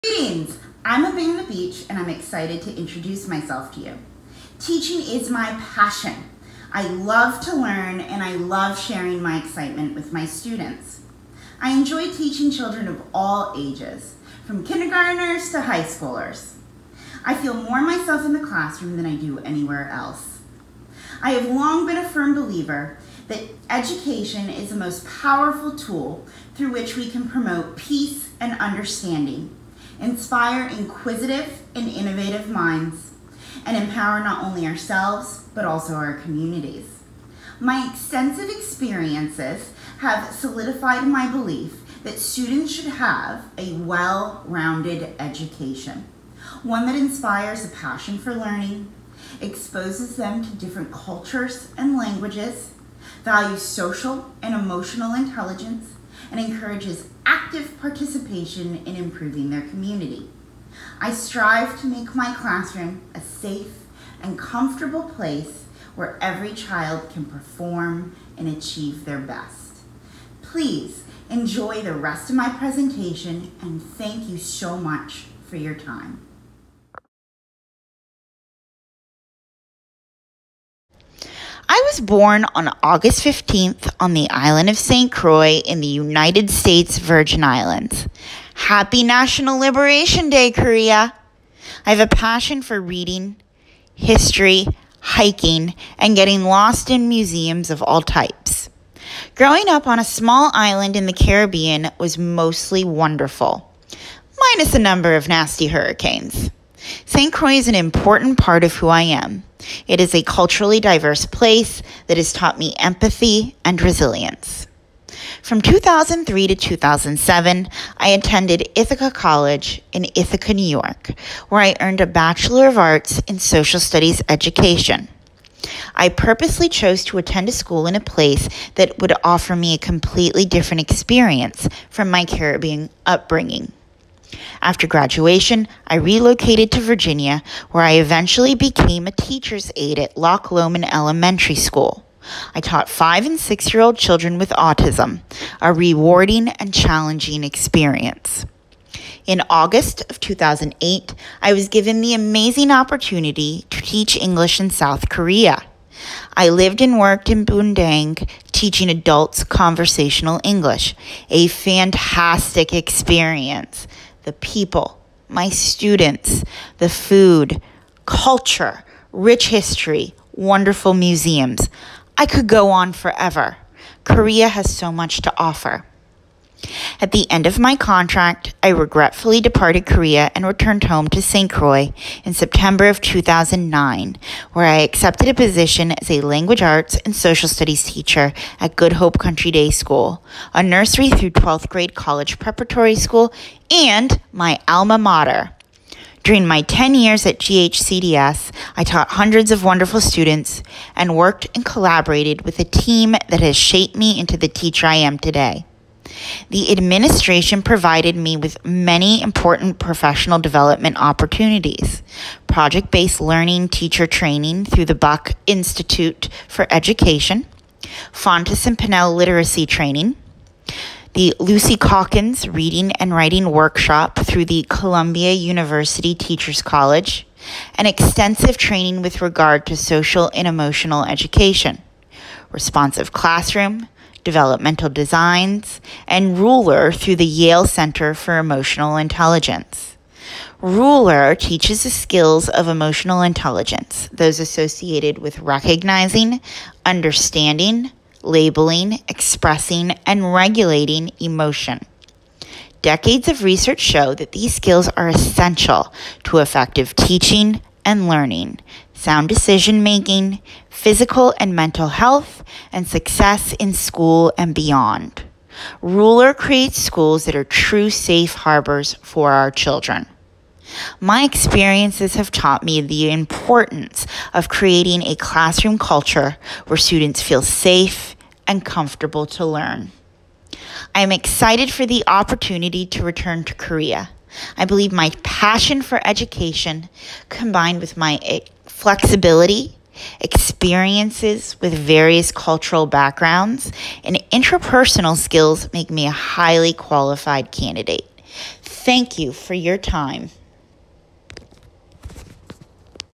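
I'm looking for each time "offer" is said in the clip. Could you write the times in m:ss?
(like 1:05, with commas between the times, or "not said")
2:09, 2:55.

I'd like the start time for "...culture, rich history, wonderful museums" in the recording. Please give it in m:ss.
2:48.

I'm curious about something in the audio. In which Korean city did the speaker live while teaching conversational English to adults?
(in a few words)
Bundang.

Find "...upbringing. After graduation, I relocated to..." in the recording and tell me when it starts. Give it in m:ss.
2:13.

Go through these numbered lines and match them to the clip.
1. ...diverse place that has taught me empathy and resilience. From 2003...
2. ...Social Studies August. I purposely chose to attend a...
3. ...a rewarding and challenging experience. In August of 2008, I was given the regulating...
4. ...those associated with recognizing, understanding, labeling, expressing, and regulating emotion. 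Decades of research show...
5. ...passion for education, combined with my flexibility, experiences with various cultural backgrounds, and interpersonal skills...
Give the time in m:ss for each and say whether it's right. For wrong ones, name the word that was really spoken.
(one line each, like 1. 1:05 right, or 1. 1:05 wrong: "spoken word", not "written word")
1. 1:50 right
2. 2:03 wrong: "Education", not "August"
3. 2:25 wrong: "amazing", not "regulating"
4. 4:04 right
5. 4:45 right.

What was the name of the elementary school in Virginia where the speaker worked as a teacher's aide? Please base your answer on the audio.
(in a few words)
Loch Lomond Elementary School.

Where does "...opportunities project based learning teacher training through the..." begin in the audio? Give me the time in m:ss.
3:30.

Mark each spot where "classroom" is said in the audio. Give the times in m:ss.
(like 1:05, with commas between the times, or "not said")
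0:18, 1:02, 3:53, 4:35.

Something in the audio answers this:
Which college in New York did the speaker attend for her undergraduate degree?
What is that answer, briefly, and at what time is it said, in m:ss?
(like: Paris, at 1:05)
Ithaca College, at 1:58.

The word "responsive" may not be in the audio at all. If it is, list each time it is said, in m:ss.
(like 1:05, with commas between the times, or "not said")
3:52.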